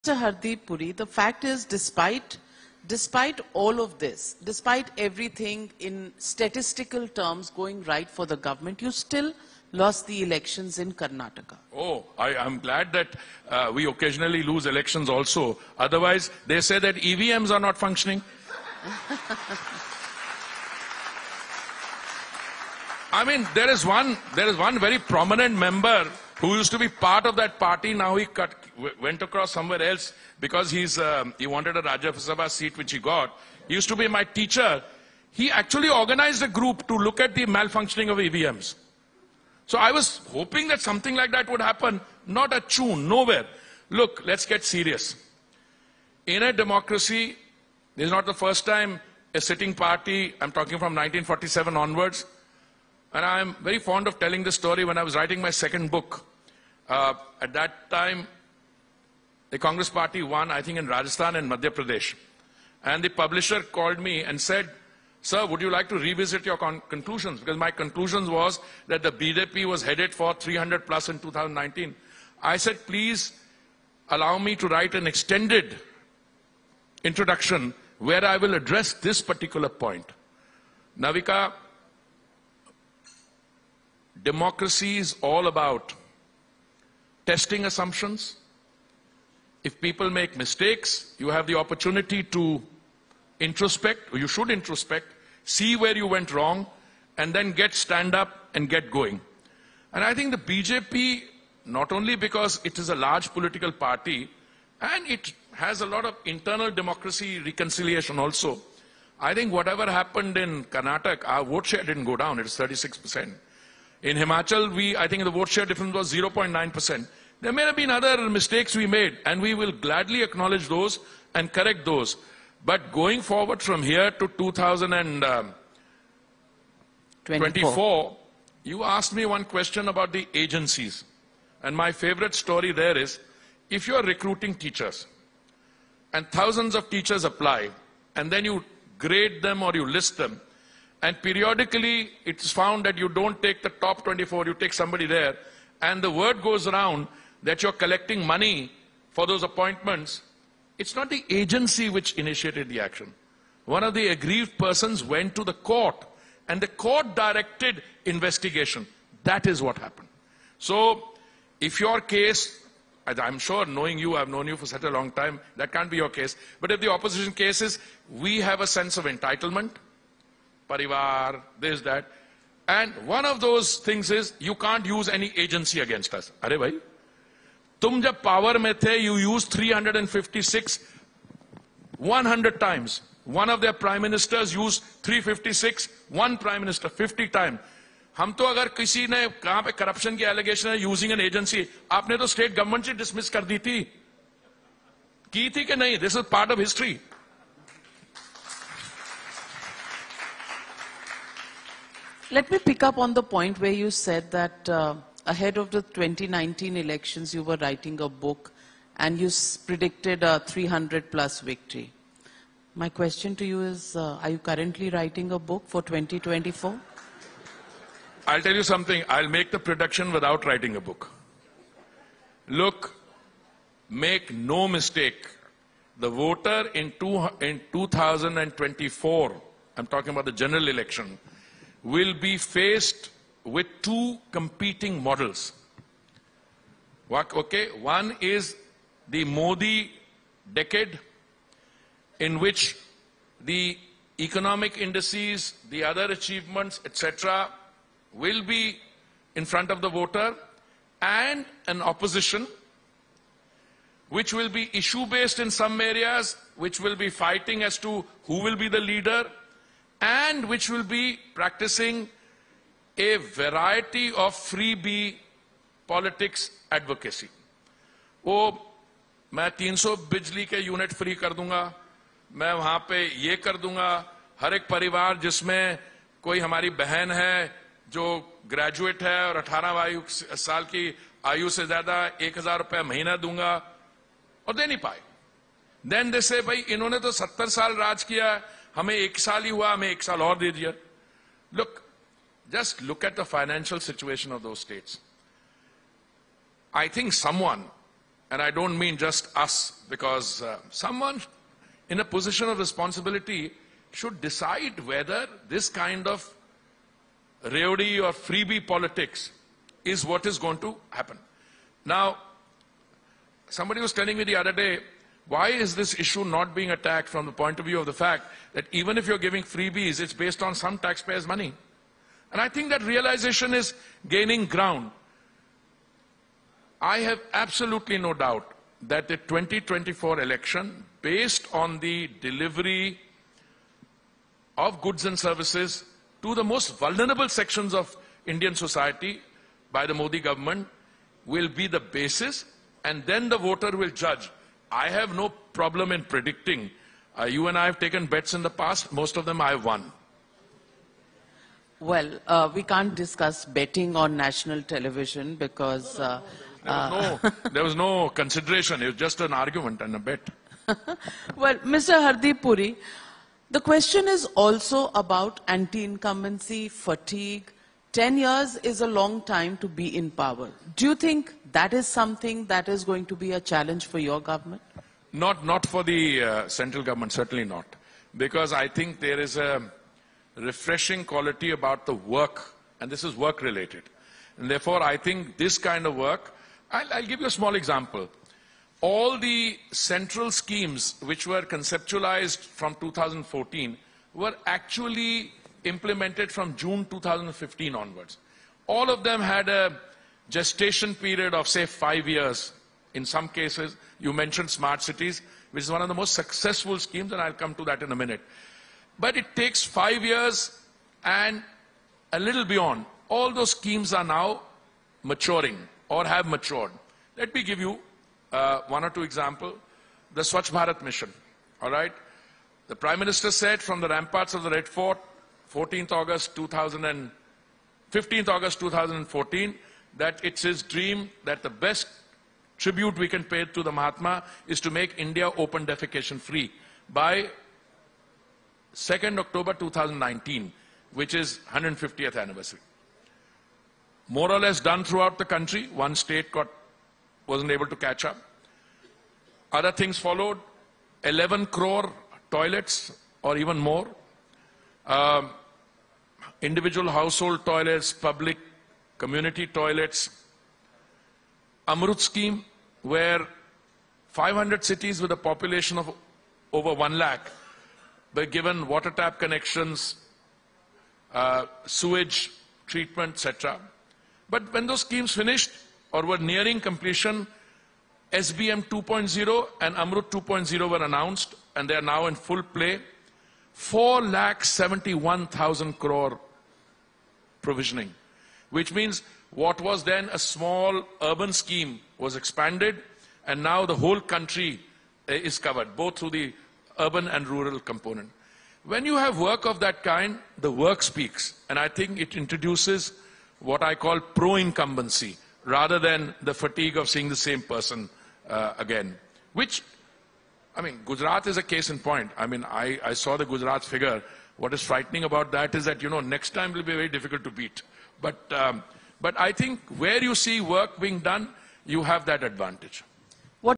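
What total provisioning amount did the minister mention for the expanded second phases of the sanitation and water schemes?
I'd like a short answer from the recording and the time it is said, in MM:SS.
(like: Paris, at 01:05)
4,71,000 crore, at 08:03.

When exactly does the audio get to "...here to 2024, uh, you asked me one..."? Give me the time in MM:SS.
02:03.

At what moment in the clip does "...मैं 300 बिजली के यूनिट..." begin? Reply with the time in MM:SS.
04:29.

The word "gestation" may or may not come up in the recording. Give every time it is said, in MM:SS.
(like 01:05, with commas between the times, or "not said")
06:40.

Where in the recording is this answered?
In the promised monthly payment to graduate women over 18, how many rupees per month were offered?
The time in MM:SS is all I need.
04:42.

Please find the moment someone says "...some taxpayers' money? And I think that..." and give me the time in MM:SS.
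05:20.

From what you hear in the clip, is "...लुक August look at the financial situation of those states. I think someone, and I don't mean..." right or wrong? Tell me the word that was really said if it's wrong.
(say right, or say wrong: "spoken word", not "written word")
wrong: "Just", not "August".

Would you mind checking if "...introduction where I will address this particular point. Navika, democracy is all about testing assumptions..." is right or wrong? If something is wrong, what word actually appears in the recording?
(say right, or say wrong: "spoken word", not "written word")
right.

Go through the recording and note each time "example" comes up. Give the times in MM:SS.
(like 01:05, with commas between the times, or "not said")
06:27, 06:59.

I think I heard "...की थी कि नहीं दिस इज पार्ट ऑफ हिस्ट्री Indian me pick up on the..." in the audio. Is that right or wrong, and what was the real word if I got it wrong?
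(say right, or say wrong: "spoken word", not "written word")
wrong: "Let", not "Indian".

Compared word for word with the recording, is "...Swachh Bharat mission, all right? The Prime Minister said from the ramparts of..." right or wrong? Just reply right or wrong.
right.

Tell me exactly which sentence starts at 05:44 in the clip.
I have no problem in predicting.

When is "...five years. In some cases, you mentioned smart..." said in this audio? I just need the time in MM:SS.
06:41.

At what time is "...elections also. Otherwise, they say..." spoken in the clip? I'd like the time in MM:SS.
00:14.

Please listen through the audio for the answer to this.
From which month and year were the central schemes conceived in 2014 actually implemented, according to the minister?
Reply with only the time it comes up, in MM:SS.
06:36.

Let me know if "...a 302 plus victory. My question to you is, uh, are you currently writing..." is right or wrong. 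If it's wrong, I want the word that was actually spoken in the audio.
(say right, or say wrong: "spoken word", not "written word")
wrong: "300", not "302".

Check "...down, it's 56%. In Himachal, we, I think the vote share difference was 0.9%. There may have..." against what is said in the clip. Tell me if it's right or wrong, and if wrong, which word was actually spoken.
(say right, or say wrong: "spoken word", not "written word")
wrong: "36", not "56".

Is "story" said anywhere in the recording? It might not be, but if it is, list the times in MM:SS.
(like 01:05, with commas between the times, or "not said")
00:54, 02:12.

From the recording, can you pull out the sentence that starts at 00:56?
Uh, at that time, the Congress party won, I think, in Rajasthan and Madhya Pradesh.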